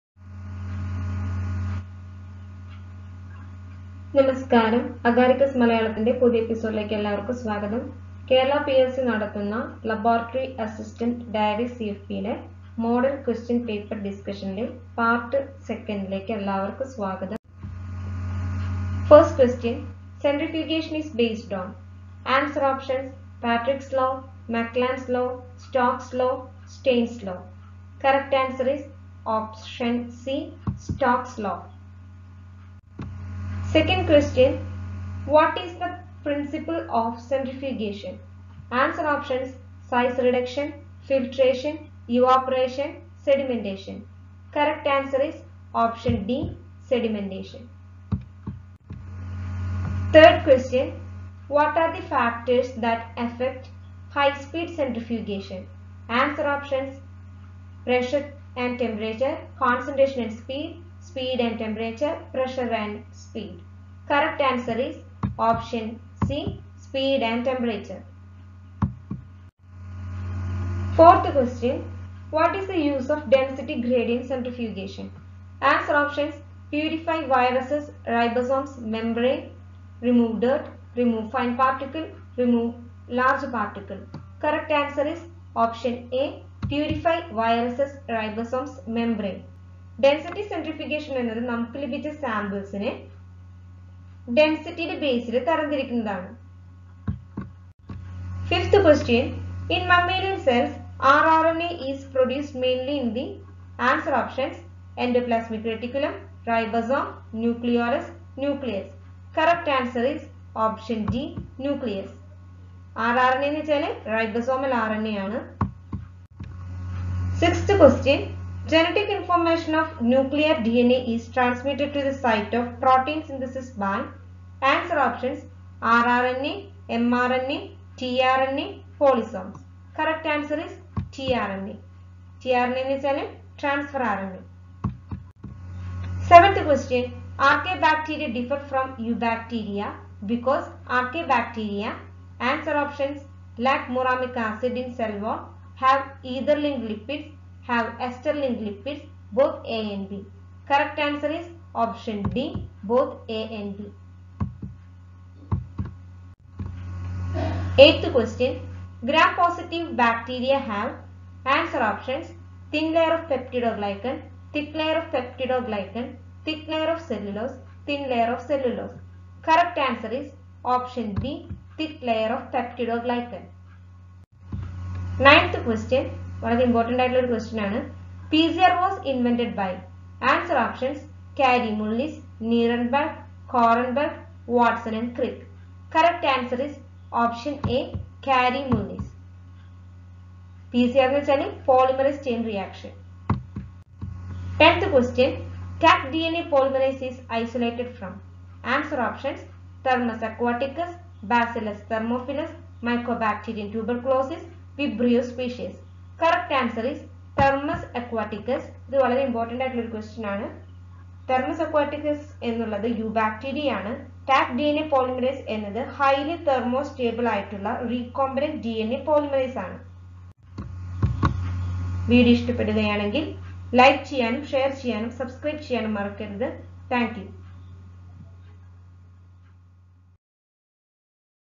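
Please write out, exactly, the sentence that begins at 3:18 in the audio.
Answer options Thermus aquaticus, Bacillus thermophilus, Mycobacterium tuberculosis, Vibrio species.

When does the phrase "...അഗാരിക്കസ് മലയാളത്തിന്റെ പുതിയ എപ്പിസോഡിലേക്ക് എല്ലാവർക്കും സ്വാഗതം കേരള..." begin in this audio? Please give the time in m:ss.
0:05.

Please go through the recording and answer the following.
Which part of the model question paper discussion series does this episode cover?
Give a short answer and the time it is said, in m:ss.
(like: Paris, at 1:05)
Part 2, at 0:14.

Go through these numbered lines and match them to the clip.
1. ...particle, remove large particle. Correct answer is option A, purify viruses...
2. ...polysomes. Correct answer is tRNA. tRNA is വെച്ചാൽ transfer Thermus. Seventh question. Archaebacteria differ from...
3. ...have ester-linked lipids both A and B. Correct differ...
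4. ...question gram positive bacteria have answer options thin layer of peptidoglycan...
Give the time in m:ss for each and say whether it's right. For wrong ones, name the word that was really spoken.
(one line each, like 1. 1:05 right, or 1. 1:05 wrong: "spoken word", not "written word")
1. 1:21 right
2. 2:08 wrong: "RNA", not "Thermus"
3. 2:27 wrong: "answer", not "differ"
4. 2:38 right.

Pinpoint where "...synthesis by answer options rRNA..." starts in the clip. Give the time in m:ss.
2:03.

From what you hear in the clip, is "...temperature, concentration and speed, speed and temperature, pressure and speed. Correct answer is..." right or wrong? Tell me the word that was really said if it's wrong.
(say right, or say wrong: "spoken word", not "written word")
right.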